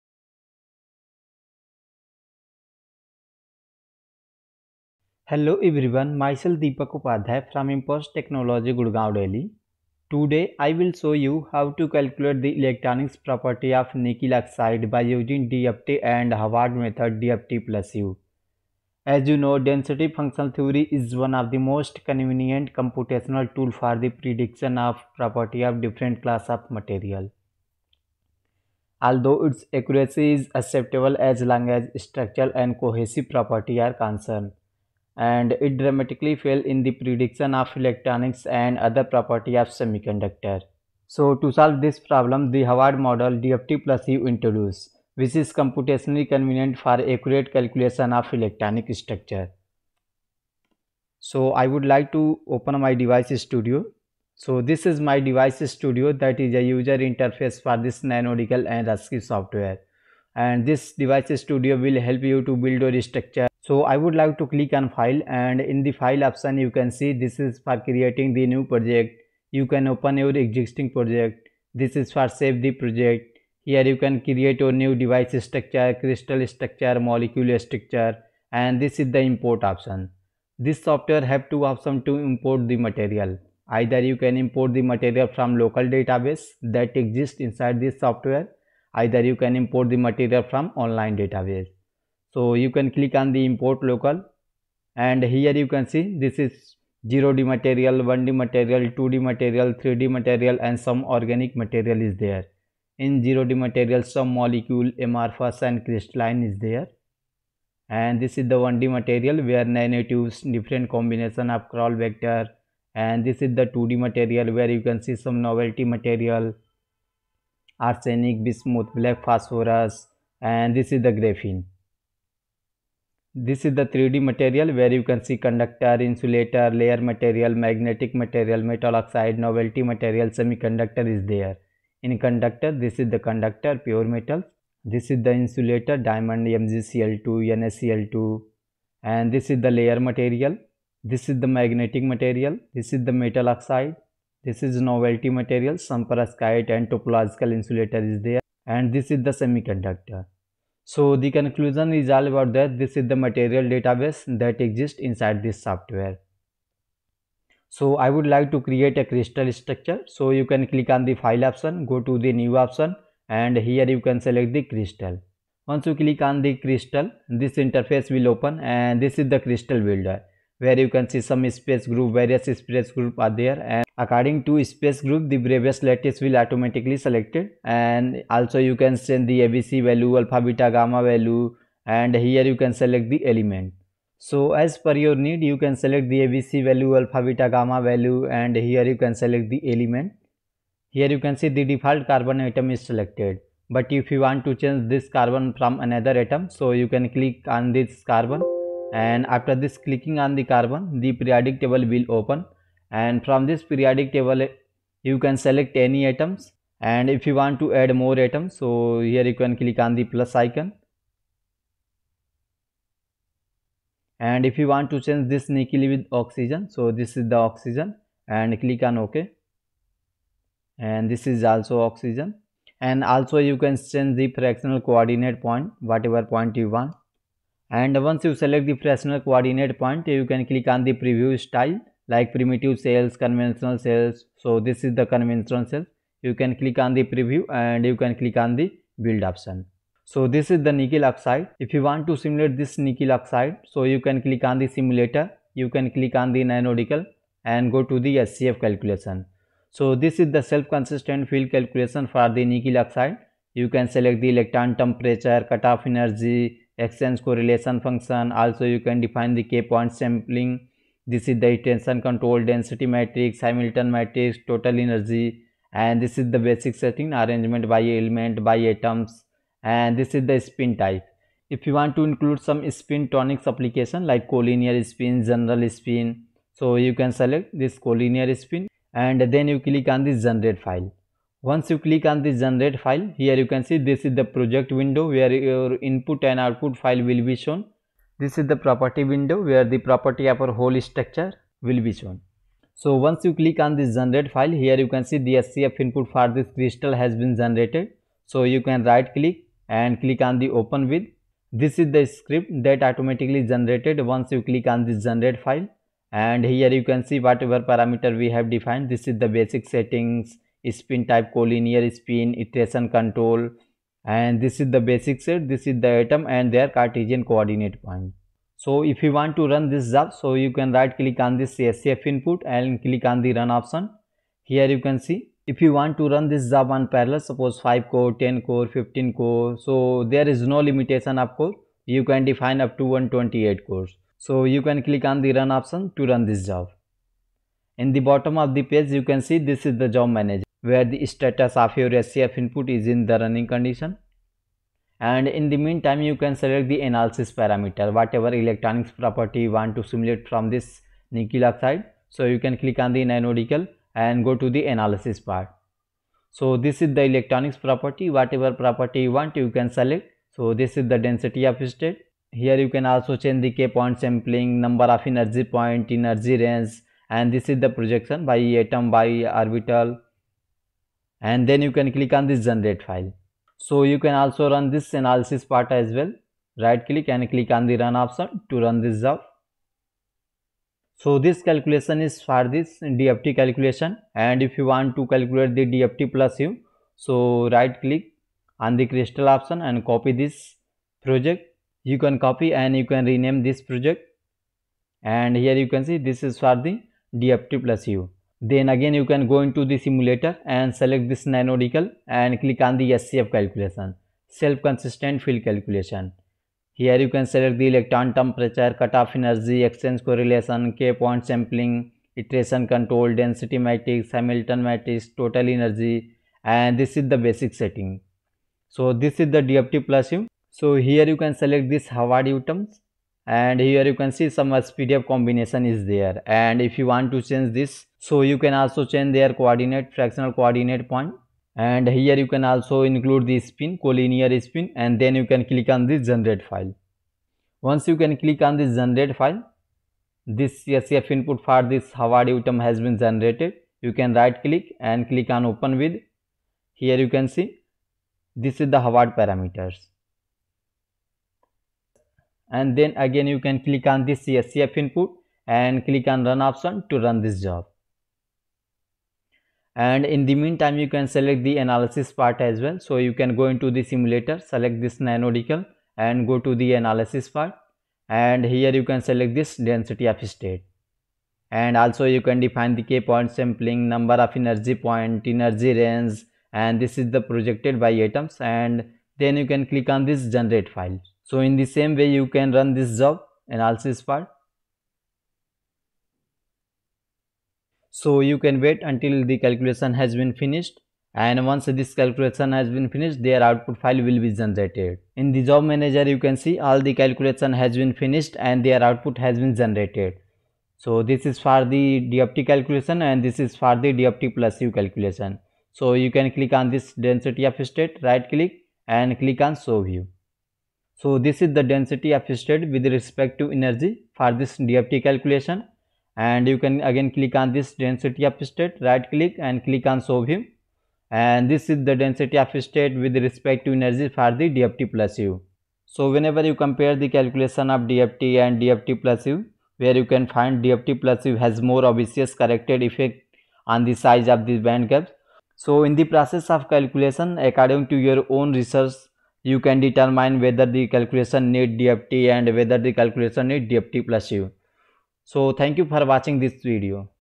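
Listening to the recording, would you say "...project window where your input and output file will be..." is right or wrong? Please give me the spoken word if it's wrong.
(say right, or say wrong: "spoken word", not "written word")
right.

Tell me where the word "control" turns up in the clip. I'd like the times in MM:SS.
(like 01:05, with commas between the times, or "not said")
04:22, 05:12, 06:52.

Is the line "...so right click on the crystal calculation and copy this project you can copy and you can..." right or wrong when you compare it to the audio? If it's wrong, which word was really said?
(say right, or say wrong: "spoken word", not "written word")
wrong: "option", not "calculation".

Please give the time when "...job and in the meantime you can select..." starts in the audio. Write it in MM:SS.
07:37.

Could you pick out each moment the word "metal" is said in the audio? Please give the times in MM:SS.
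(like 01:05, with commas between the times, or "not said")
02:08, 02:14, 02:23.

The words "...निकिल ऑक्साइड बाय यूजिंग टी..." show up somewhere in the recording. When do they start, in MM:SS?
00:13.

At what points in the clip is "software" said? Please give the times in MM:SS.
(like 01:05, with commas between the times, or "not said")
00:59, 01:20, 01:27, 02:35.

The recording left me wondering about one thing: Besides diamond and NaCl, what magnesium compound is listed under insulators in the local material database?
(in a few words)
MgCl2.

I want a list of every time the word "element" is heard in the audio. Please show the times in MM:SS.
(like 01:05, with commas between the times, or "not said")
03:03, 03:09, 04:27.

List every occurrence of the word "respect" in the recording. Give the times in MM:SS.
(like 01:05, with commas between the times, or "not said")
08:32, 08:43.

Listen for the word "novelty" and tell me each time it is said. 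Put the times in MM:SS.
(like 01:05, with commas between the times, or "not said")
01:55, 02:09, 02:24.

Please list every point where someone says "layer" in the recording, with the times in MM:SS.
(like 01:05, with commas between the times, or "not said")
02:06, 02:19.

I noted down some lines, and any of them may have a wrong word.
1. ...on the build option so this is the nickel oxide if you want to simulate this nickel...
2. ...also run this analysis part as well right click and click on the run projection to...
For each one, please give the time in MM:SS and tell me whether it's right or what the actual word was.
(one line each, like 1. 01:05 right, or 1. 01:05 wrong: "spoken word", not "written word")
1. 03:58 right
2. 06:14 wrong: "option", not "projection".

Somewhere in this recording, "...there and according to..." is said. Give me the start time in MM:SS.
02:53.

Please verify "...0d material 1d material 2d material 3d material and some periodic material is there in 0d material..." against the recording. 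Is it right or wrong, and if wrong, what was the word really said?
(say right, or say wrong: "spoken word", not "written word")
wrong: "organic", not "periodic".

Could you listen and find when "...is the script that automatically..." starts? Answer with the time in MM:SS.
05:01.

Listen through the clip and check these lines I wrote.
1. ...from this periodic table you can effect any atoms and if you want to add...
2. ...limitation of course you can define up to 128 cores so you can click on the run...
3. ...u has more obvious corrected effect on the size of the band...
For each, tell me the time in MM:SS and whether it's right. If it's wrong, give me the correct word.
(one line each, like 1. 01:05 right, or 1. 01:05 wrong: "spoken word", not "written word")
1. 03:23 wrong: "select", not "effect"
2. 05:30 right
3. 08:51 right.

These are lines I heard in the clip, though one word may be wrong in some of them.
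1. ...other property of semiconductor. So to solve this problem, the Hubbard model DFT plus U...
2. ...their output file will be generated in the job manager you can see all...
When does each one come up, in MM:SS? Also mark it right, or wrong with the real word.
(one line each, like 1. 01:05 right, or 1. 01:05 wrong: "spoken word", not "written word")
1. 00:38 right
2. 08:13 right.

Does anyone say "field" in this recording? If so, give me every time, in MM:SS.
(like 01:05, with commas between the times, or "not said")
04:11, 06:45.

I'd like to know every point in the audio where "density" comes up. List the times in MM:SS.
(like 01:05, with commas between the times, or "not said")
04:22, 06:00, 06:53, 07:49, 08:26, 08:31, 08:37, 08:41.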